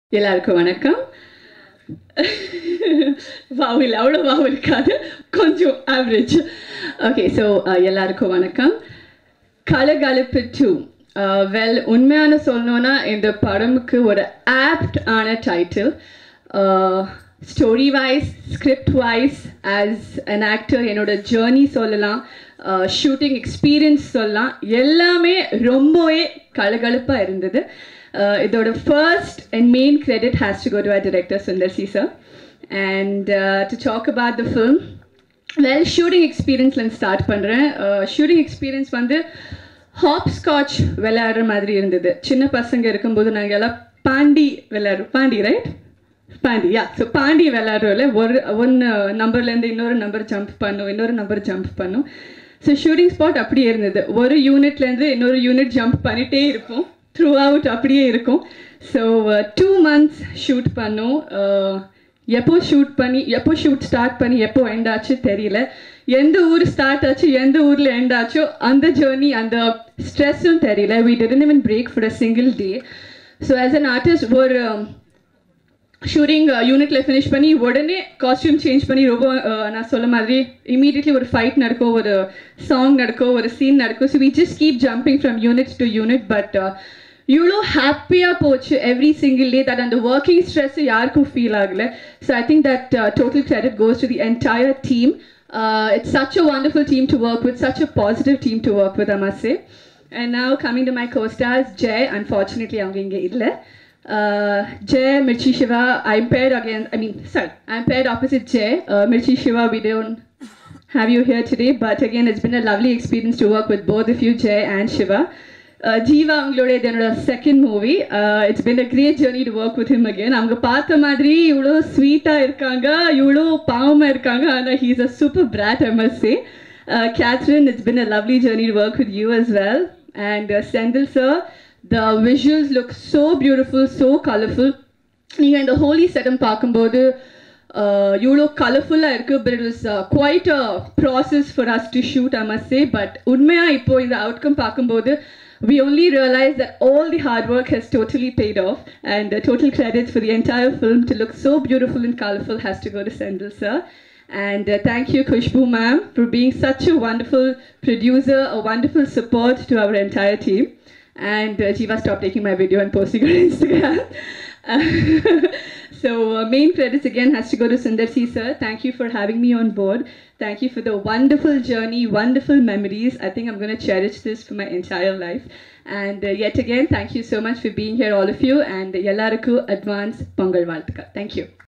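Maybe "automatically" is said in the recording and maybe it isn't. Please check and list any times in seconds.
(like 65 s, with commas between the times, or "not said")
not said.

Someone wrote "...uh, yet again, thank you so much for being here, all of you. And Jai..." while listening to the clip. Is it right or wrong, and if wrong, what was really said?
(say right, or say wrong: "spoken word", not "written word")
wrong: "Yallaraku", not "Jai".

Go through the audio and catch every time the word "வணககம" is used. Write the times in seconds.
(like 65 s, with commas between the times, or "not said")
0 s, 8 s.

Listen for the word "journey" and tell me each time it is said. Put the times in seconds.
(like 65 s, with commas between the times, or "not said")
171 s.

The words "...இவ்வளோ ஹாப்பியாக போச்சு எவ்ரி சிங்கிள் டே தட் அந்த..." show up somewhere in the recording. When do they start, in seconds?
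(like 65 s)
87 s.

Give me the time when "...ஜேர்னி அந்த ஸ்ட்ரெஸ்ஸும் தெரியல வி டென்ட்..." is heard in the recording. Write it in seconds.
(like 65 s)
68 s.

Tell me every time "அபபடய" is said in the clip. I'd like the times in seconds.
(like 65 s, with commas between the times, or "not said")
53 s, 57 s.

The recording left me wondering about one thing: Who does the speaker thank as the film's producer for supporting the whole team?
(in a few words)
Kushbu.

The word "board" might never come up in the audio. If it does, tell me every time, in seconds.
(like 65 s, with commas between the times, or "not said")
169 s.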